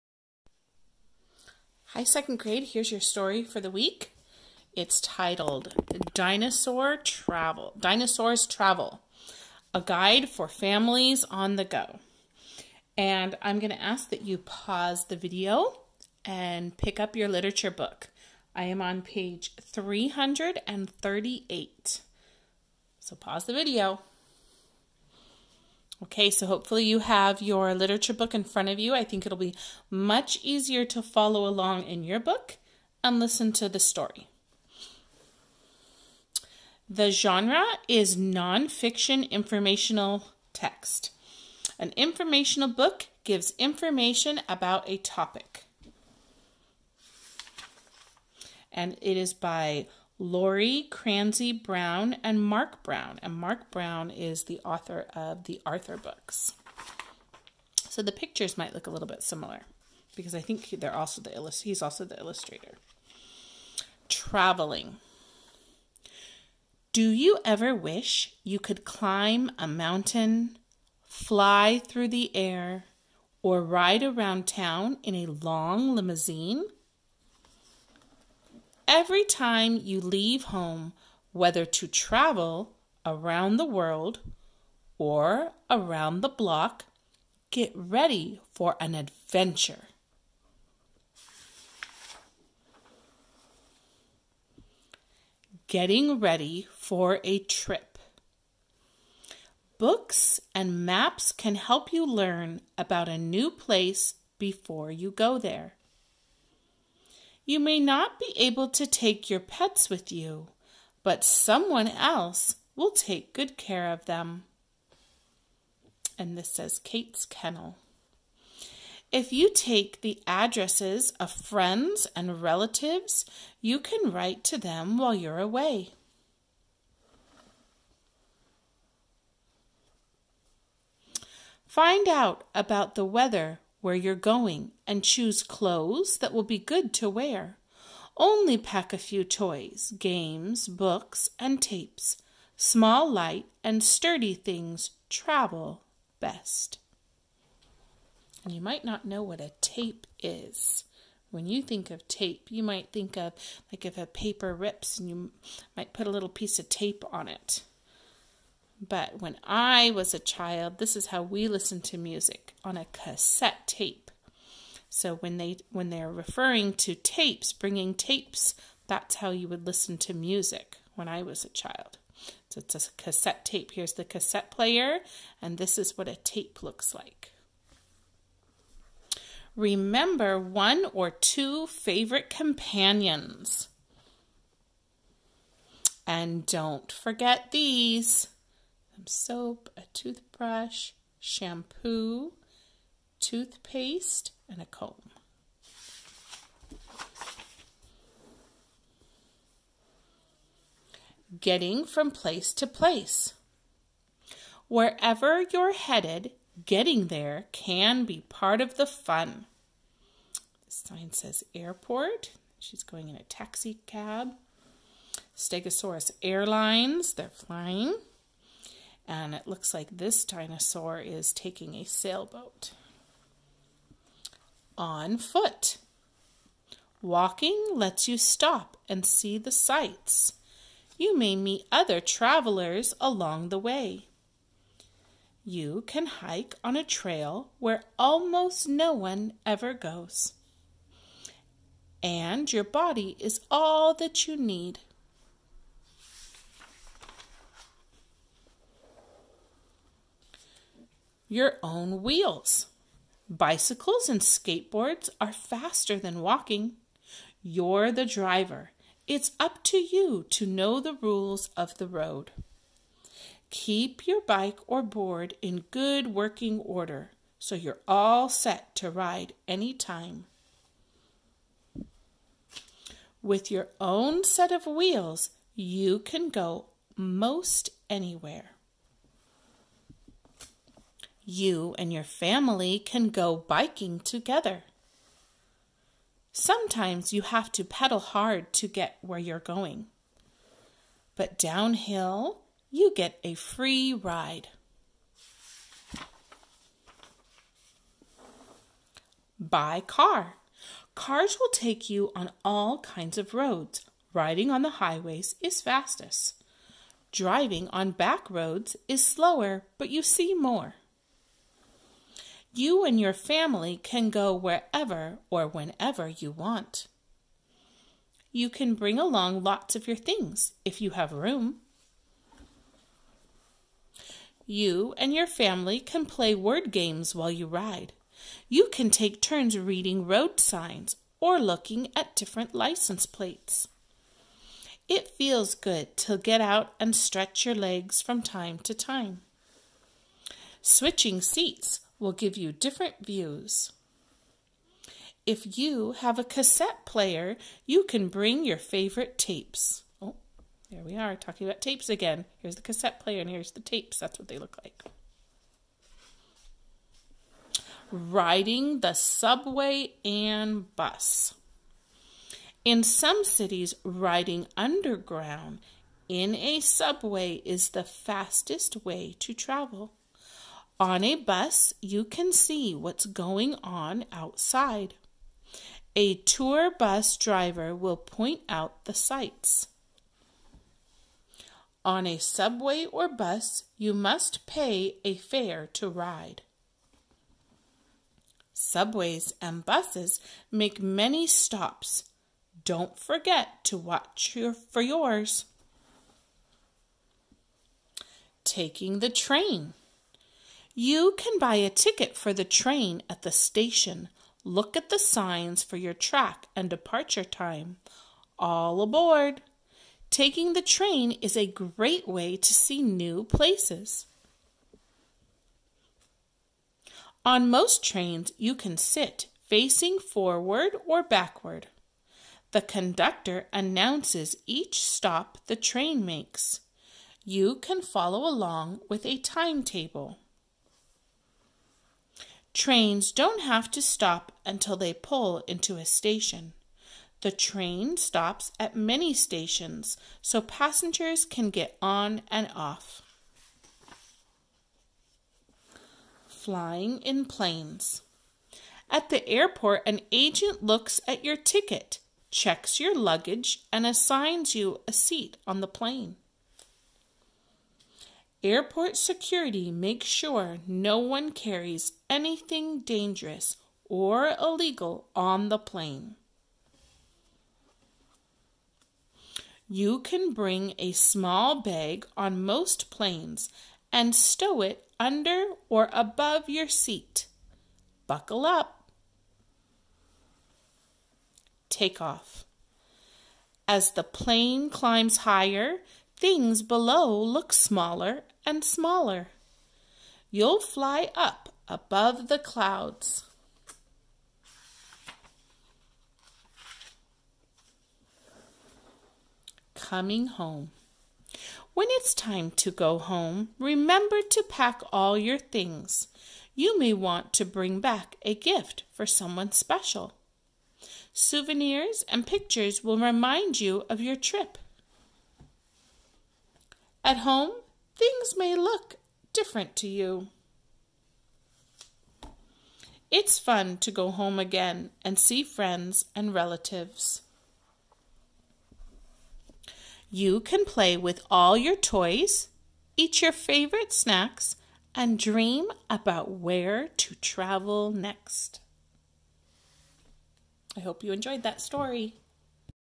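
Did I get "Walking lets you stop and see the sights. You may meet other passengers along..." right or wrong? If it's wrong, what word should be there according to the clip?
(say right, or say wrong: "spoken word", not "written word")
wrong: "travelers", not "passengers".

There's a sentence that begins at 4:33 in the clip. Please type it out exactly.
With your own set of wheels, you can go most anywhere.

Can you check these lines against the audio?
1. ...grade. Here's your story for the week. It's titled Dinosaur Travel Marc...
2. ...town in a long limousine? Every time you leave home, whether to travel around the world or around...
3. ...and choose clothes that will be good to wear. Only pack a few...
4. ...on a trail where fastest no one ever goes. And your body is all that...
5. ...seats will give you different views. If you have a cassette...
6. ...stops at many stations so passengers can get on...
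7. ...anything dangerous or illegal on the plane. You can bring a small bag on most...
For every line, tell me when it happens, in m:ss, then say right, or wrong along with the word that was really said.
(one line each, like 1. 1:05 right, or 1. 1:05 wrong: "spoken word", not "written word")
1. 0:02 wrong: "Dinosaurs", not "Marc"
2. 1:14 right
3. 2:14 right
4. 3:56 wrong: "almost", not "fastest"
5. 5:41 right
6. 7:17 right
7. 7:42 right.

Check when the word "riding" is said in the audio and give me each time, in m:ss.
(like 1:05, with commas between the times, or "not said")
5:04, 5:57, 6:03.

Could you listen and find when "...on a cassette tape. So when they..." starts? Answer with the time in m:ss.
2:42.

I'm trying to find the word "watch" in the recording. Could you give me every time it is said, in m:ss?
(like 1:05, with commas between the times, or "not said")
6:33.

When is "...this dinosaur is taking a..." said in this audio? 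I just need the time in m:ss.
3:39.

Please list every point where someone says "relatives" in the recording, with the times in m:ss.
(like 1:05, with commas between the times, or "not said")
2:02, 8:46.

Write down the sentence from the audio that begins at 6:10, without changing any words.
On a bus, you can see what's going on outside.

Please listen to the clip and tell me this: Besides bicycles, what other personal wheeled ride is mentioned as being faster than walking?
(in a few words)
skateboards.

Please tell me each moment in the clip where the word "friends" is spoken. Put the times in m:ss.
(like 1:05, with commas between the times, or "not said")
2:01, 8:45.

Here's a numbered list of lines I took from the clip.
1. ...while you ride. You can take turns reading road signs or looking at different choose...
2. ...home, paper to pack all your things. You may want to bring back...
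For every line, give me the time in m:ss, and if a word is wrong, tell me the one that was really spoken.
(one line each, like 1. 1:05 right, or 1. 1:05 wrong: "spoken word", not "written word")
1. 5:27 wrong: "license", not "choose"
2. 8:22 wrong: "remember", not "paper".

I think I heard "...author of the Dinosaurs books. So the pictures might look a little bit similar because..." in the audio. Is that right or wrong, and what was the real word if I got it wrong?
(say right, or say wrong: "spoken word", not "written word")
wrong: "Arthur", not "Dinosaurs".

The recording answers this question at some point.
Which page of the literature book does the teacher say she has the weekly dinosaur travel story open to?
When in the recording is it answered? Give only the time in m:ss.
0:19.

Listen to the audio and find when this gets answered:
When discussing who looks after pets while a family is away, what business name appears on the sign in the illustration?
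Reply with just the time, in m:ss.
1:56.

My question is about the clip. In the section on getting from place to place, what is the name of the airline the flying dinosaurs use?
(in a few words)
Stegosaurus Airlines.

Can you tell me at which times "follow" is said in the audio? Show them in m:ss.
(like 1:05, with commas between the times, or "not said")
0:31, 7:07.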